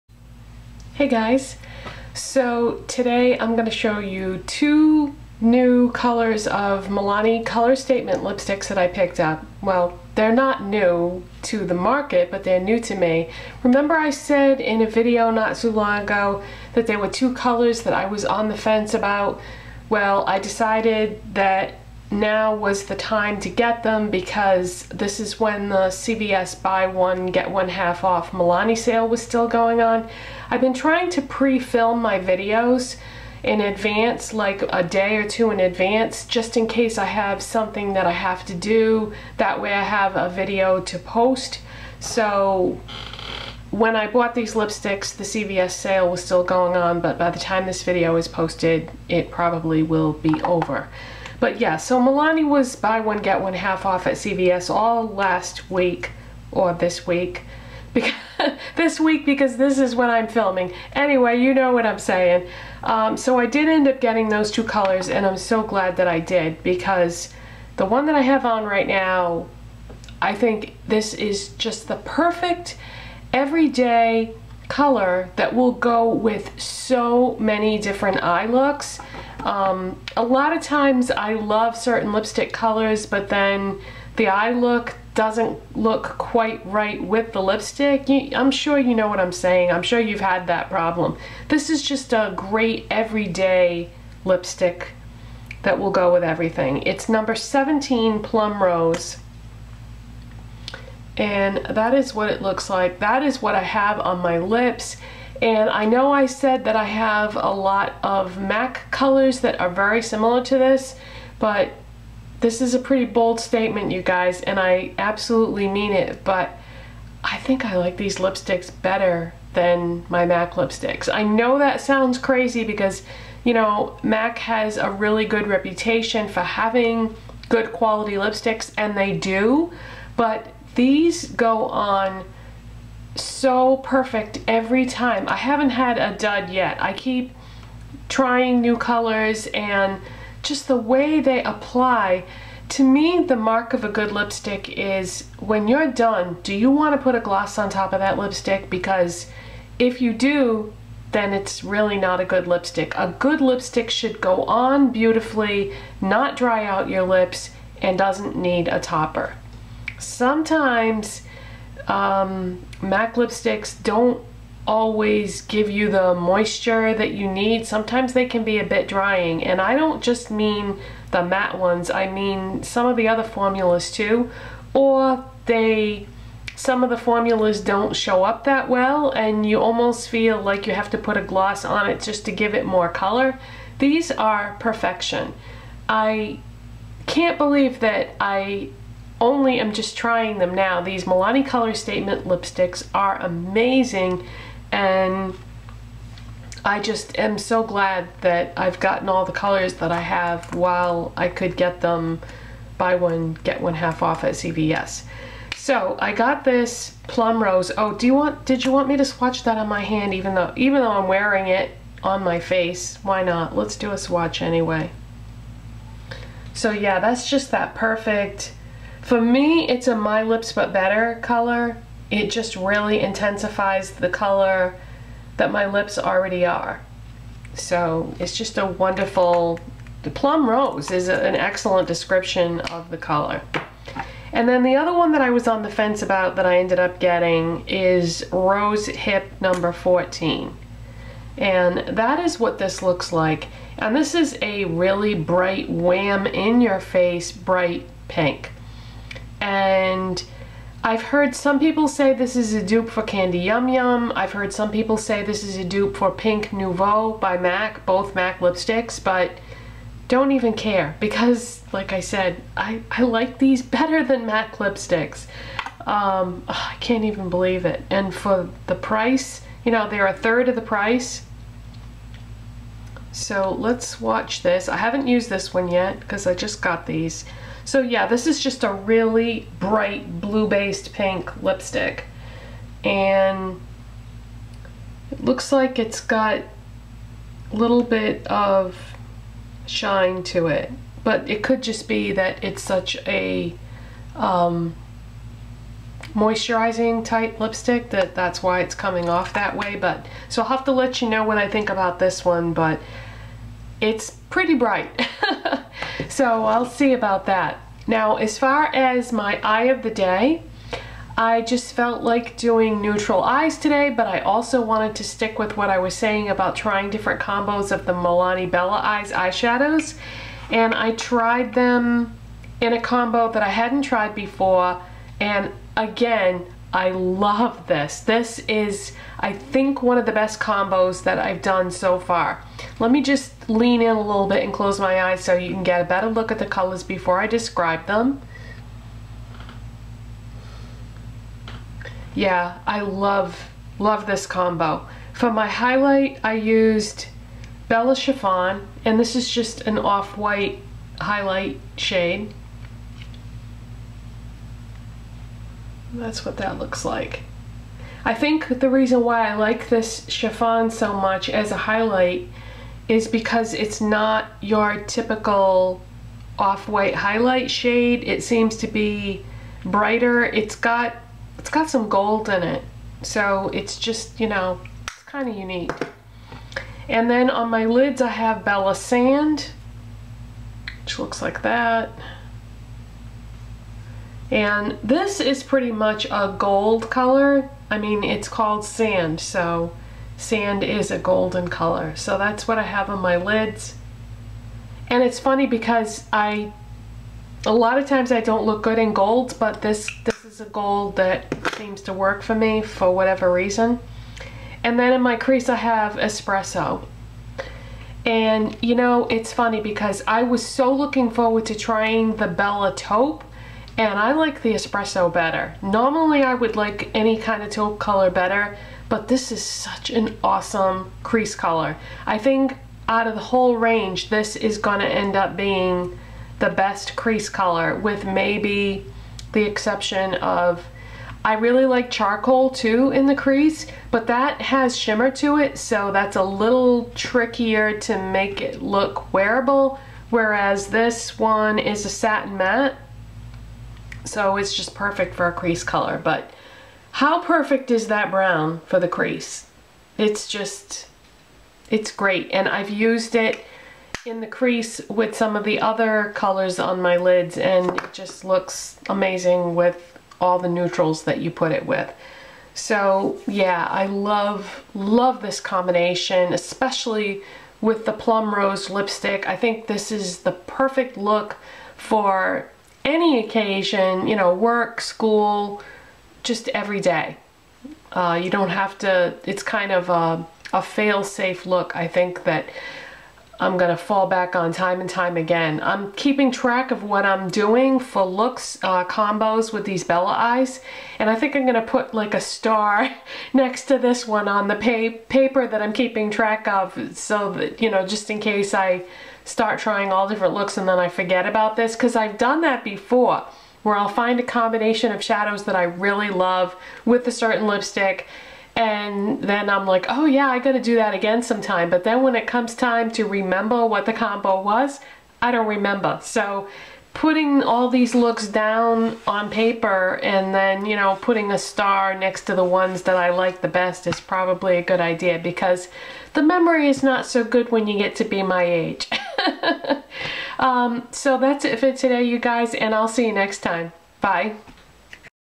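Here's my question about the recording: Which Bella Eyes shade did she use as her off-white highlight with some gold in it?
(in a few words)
Bella Chiffon.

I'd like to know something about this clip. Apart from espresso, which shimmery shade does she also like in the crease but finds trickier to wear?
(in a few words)
charcoal.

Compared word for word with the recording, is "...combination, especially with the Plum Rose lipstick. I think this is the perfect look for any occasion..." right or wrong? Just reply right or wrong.
right.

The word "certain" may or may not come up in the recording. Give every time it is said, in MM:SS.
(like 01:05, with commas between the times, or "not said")
01:21, 08:27.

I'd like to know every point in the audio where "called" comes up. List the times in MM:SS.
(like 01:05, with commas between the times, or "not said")
06:28.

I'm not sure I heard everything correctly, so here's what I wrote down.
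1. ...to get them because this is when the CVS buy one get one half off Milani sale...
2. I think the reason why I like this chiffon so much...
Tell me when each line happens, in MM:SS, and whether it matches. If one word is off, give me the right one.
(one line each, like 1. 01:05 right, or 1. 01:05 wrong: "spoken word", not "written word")
1. 00:23 right
2. 05:58 right.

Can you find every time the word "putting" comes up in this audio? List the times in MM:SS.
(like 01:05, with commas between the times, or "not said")
08:36, 08:41.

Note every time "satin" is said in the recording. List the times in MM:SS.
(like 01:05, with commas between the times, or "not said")
07:21.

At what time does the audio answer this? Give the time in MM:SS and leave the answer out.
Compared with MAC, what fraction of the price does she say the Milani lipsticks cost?
04:30.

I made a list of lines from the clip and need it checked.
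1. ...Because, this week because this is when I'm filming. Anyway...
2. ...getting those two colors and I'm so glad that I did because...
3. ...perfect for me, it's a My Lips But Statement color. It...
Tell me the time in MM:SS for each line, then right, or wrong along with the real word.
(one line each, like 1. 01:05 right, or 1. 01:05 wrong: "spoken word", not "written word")
1. 00:57 right
2. 01:03 right
3. 03:37 wrong: "Better", not "Statement".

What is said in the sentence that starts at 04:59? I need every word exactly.
But So I'll have to let you know what I think about this one, but it's pretty bright.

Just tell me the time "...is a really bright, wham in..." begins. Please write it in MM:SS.
04:04.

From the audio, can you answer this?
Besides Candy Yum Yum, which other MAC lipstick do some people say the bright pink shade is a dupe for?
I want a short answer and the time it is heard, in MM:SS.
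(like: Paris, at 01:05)
Pink Nouveau, at 04:16.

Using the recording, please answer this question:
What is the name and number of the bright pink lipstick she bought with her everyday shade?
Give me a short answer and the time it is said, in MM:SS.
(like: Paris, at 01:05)
Rose Hip number 14, at 03:58.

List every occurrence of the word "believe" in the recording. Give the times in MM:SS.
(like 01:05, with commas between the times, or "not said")
03:07, 04:27.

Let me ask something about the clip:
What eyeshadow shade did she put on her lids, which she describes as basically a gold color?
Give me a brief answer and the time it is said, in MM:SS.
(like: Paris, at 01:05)
Bella Sand, at 06:18.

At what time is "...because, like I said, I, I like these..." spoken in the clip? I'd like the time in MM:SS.
04:20.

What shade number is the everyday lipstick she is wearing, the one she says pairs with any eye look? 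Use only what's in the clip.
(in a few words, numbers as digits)
17.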